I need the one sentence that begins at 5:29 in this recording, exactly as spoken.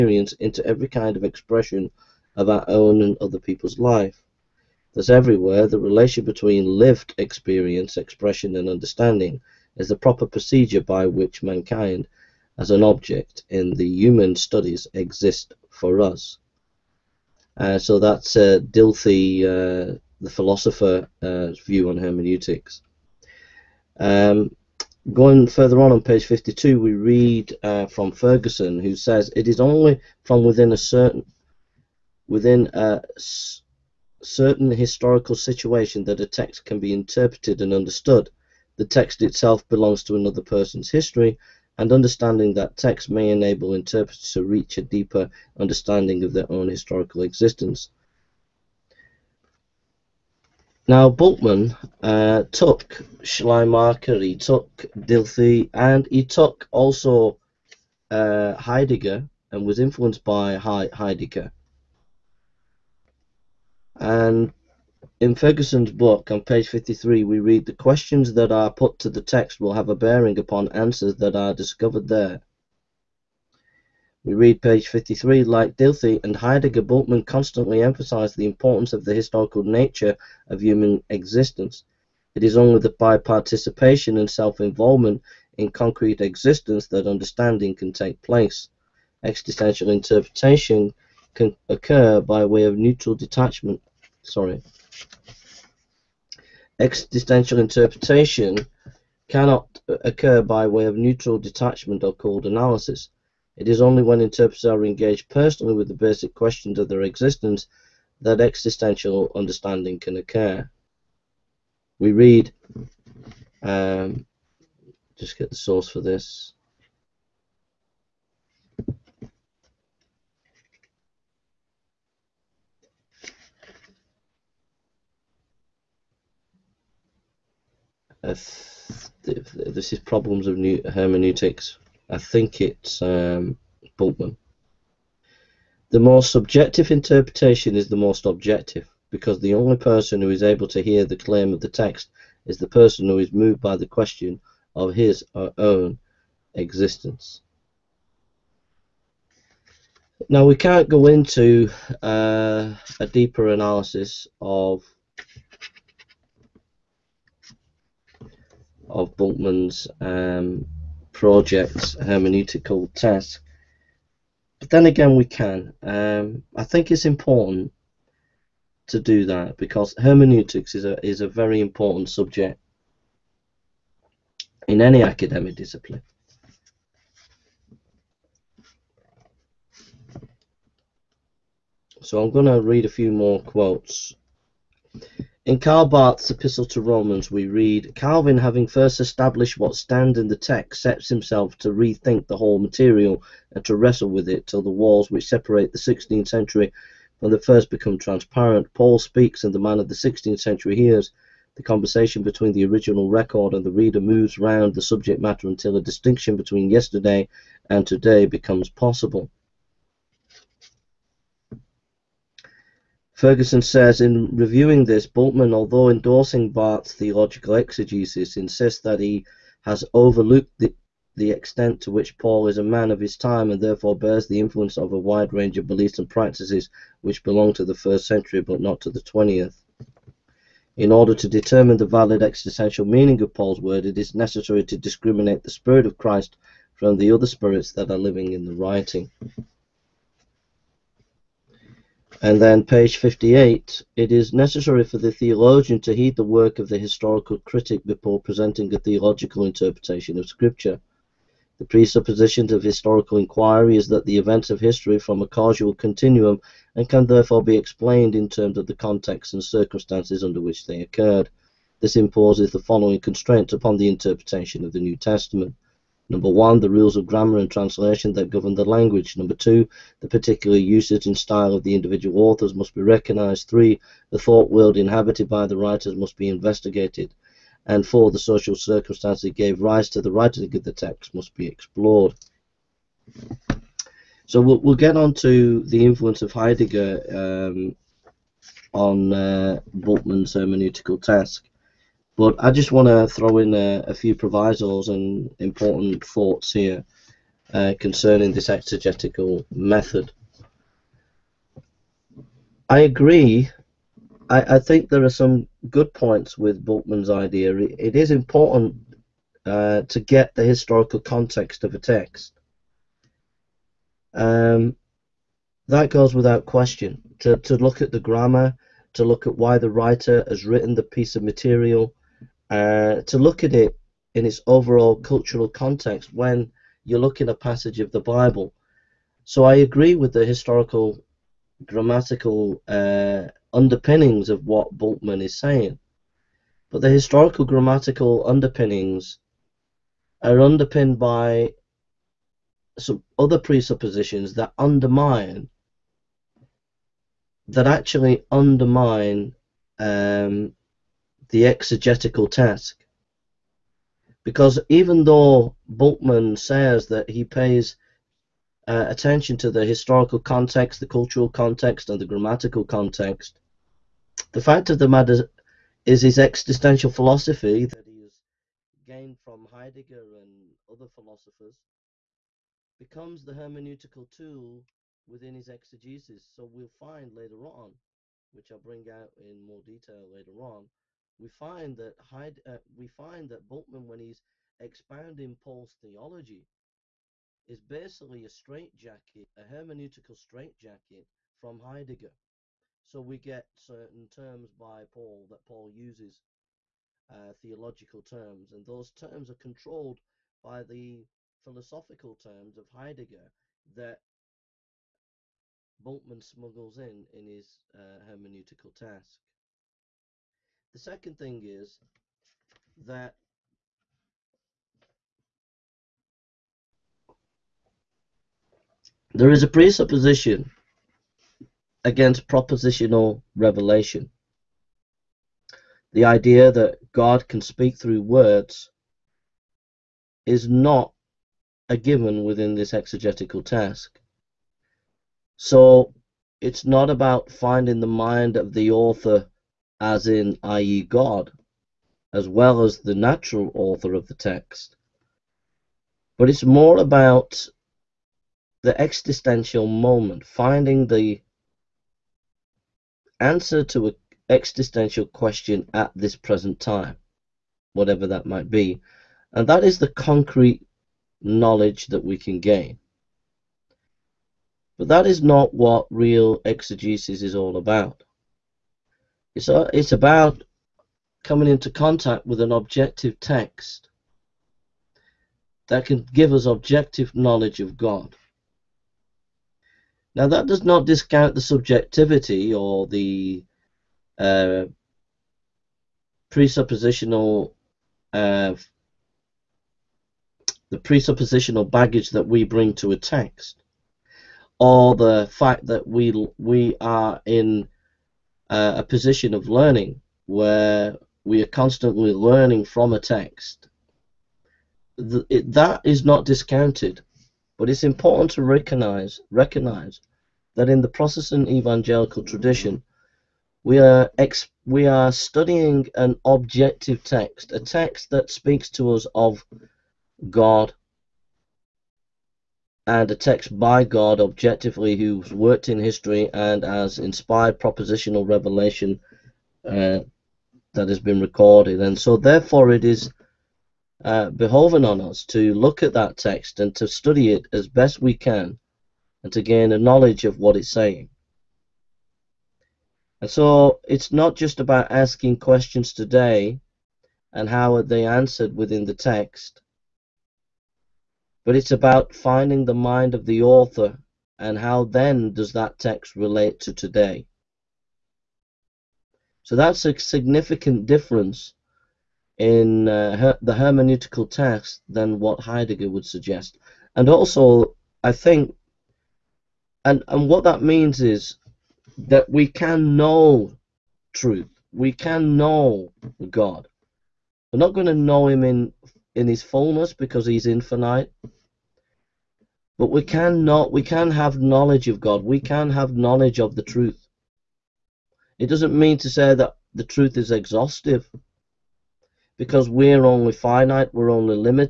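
So I agree with the historical grammatical uh, underpinnings of what Bultmann is saying.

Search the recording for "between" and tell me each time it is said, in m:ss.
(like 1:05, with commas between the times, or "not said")
0:06, 3:22, 3:26.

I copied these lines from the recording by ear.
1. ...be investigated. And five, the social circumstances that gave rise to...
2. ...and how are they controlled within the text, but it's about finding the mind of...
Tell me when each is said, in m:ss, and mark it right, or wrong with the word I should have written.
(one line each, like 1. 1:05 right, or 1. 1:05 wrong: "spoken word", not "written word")
1. 4:36 wrong: "four", not "five"
2. 9:07 wrong: "answered", not "controlled".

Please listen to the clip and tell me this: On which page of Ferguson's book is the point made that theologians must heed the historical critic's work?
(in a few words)
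58.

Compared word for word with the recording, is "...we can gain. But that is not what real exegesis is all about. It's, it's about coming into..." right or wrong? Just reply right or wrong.
right.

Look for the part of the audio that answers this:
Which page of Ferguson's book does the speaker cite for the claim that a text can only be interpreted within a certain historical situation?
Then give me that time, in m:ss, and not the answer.
0:26.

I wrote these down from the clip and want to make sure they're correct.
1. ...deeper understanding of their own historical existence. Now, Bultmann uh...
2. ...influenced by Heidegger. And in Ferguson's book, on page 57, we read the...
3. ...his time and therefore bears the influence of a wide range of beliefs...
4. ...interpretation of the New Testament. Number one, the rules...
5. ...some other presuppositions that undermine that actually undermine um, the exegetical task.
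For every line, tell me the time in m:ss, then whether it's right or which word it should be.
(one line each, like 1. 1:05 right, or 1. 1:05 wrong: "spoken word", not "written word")
1. 0:44 right
2. 0:59 wrong: "53", not "57"
3. 3:42 right
4. 4:23 right
5. 5:42 right.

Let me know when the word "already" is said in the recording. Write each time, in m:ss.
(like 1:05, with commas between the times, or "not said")
not said.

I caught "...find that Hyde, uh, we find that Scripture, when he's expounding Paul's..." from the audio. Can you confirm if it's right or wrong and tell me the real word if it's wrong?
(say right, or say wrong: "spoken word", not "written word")
wrong: "Bultmann", not "Scripture".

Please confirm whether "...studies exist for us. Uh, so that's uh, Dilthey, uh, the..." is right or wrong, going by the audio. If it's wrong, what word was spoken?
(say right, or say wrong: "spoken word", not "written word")
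right.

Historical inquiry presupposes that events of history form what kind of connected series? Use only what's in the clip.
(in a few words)
causal continuum.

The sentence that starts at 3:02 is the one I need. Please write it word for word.
So I'm going to read a few more quotes.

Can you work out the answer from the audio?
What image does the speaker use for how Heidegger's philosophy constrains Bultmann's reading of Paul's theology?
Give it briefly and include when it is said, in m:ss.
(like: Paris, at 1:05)
hermeneutical straitjacket, at 6:29.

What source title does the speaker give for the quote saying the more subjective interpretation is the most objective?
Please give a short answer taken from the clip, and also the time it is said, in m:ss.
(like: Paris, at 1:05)
Problems of New Hermeneutics, at 2:09.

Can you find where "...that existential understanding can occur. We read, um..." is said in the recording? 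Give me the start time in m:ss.
1:48.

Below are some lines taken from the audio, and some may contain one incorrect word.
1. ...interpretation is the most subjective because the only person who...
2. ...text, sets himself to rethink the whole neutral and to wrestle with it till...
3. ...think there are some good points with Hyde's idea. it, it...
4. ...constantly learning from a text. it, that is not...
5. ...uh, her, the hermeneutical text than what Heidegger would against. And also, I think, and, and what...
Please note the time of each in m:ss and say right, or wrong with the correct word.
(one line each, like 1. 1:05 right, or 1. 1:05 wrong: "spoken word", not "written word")
1. 2:16 wrong: "objective", not "subjective"
2. 3:10 wrong: "material", not "neutral"
3. 5:04 wrong: "Bultmann", not "Hyde"
4. 8:21 right
5. 9:22 wrong: "suggest", not "against".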